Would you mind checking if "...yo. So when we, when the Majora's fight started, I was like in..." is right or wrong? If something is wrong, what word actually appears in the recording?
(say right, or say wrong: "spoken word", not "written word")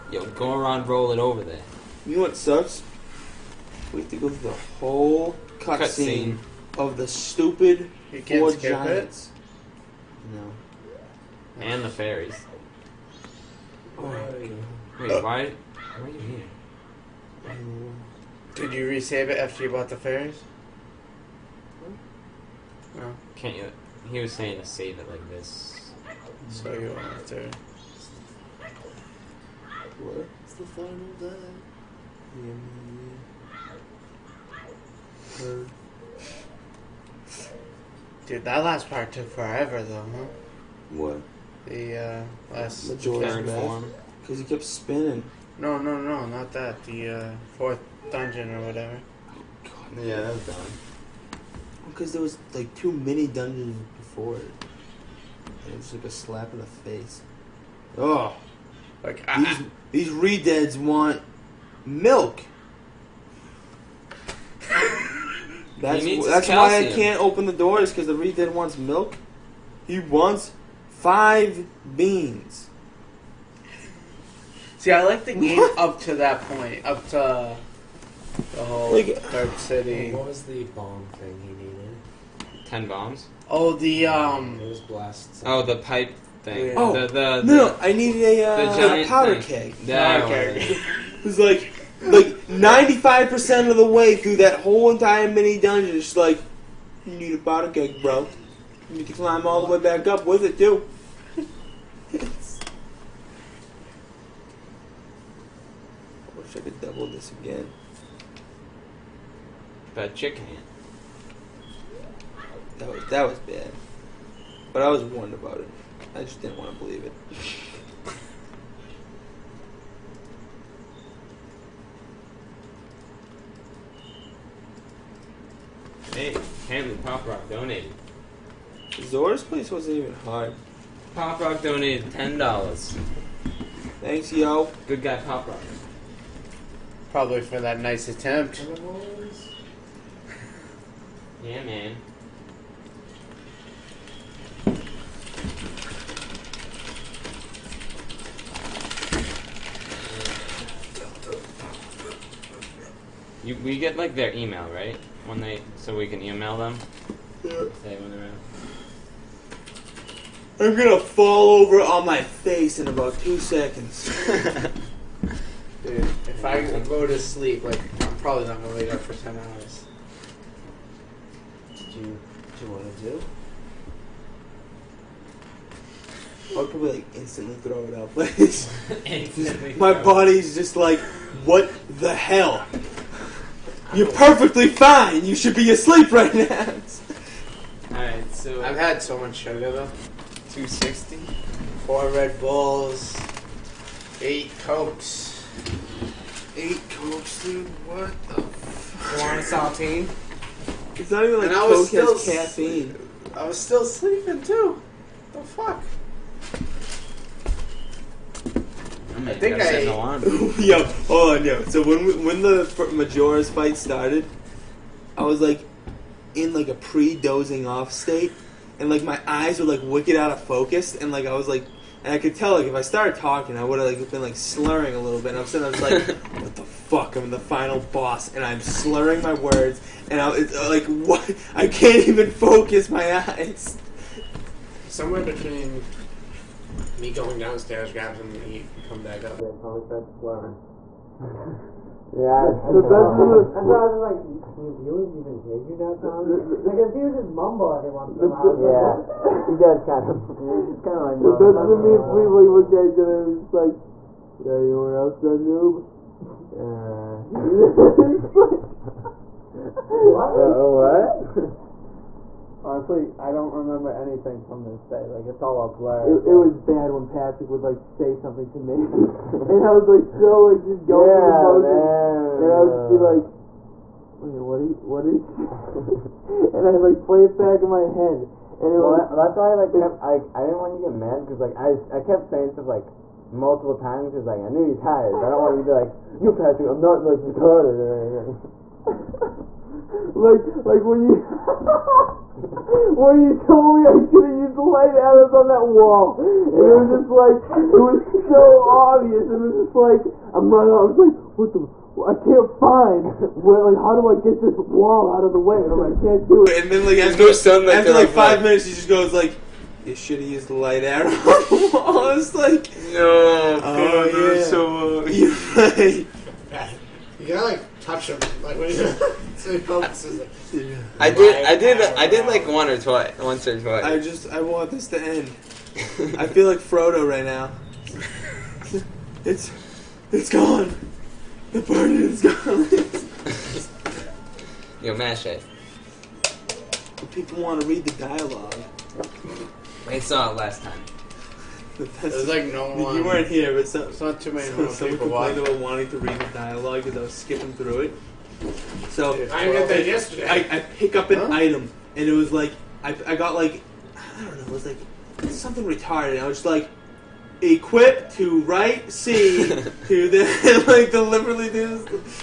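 right.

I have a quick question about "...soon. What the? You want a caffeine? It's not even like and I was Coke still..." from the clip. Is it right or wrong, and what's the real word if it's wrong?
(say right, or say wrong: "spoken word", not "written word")
wrong: "saltine", not "caffeine".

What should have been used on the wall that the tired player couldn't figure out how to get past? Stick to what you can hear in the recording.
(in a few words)
Light arrows.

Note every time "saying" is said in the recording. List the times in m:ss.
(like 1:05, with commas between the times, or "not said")
0:24, 4:42.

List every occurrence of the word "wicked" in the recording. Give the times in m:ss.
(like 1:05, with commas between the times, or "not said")
3:39.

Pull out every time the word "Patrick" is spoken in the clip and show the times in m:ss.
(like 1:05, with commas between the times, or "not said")
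4:27, 4:46.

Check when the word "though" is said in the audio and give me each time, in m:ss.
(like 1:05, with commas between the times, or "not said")
0:39, 3:09.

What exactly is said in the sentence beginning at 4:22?
Honestly, I don't remember anything from this day.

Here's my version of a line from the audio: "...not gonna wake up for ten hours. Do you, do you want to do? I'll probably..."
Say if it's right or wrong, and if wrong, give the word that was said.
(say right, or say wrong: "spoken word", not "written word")
right.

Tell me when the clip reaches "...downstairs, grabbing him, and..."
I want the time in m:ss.
3:57.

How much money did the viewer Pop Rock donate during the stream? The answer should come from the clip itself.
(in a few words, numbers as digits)
$10.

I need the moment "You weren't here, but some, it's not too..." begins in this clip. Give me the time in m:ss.
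5:42.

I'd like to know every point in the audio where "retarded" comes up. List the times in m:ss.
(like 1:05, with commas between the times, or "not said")
4:47, 5:55.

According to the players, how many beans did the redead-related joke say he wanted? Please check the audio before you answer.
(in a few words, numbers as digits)
5.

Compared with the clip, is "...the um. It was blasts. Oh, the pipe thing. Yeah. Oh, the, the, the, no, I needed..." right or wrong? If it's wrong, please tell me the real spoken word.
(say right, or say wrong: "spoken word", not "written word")
right.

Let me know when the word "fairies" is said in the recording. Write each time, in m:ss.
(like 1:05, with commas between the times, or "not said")
0:11, 0:19.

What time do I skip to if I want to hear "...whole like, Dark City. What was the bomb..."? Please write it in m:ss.
1:18.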